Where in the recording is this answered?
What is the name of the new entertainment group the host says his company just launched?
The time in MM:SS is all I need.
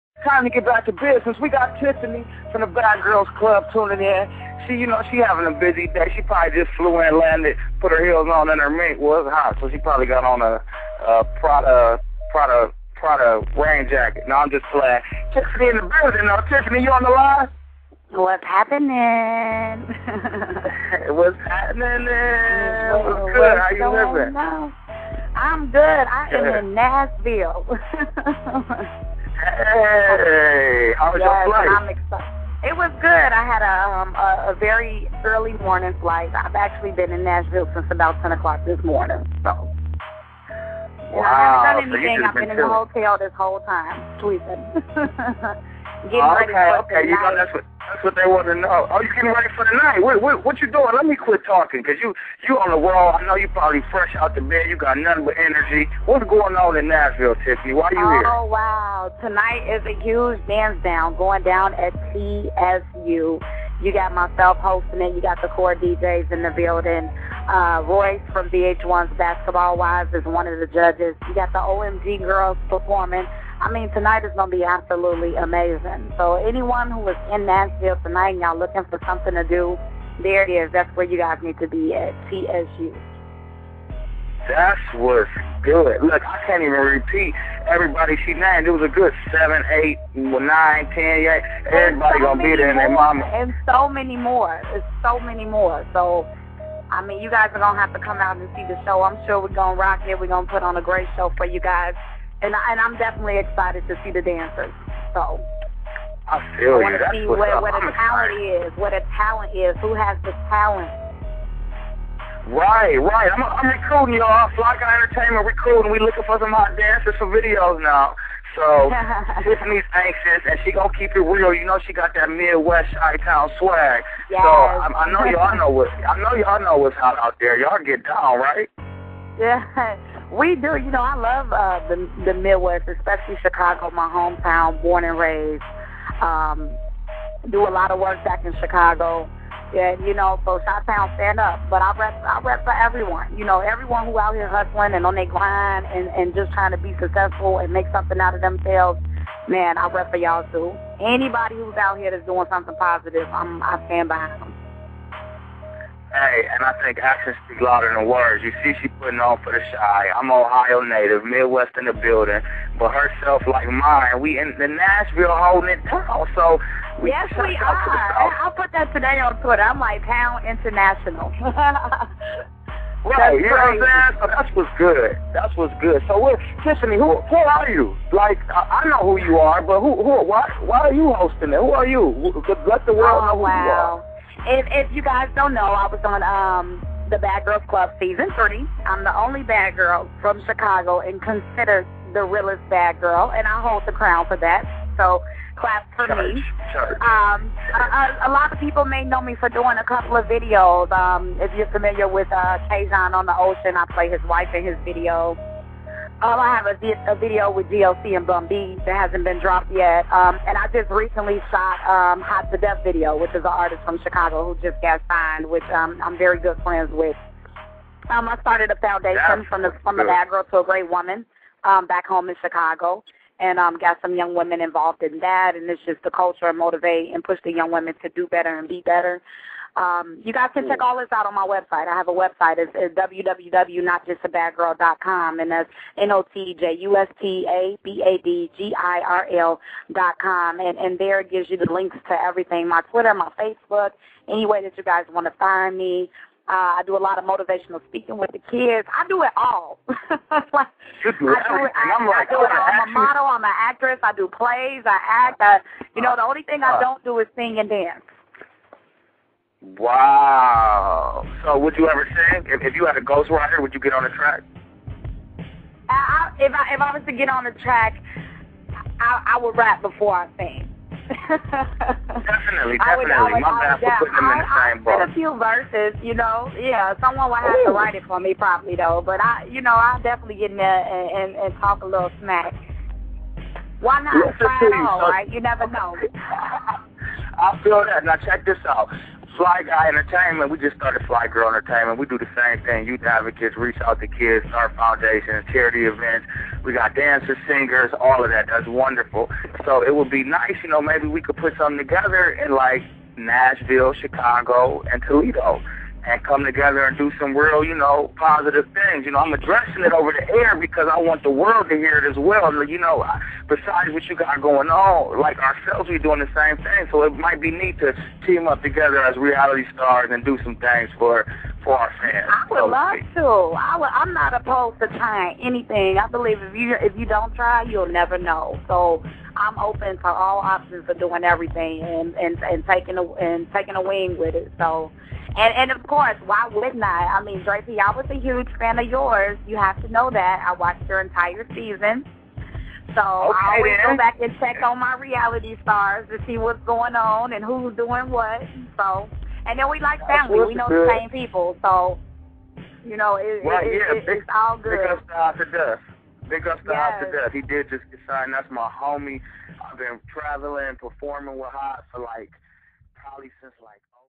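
04:51.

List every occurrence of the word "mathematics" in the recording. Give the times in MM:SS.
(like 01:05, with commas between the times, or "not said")
not said.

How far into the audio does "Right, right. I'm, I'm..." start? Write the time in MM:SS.
01:52.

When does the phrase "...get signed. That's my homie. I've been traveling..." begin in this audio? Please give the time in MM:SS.
05:57.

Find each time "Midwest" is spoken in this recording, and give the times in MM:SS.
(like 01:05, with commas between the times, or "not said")
02:02, 02:12, 02:41.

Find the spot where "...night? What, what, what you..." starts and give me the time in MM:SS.
00:49.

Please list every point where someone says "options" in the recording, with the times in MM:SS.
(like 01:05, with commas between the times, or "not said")
05:30.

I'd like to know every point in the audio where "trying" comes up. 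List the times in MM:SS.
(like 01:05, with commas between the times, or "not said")
02:26, 05:24.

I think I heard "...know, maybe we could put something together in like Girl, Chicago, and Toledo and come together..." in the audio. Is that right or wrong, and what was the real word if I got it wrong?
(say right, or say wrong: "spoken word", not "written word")
wrong: "Nashville", not "Girl".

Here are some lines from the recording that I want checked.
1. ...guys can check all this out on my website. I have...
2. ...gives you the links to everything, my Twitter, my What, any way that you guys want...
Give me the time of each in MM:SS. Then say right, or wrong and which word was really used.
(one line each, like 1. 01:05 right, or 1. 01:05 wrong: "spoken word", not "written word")
1. 03:50 right
2. 04:01 wrong: "Facebook", not "What".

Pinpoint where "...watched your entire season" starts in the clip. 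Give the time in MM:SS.
05:40.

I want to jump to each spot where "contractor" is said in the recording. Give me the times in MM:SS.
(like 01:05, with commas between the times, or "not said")
not said.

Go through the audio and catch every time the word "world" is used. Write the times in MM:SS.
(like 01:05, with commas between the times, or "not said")
03:02, 05:11.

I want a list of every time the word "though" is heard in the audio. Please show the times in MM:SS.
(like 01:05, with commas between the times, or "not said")
00:16, 04:38.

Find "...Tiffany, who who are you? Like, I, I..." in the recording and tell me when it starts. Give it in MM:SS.
02:56.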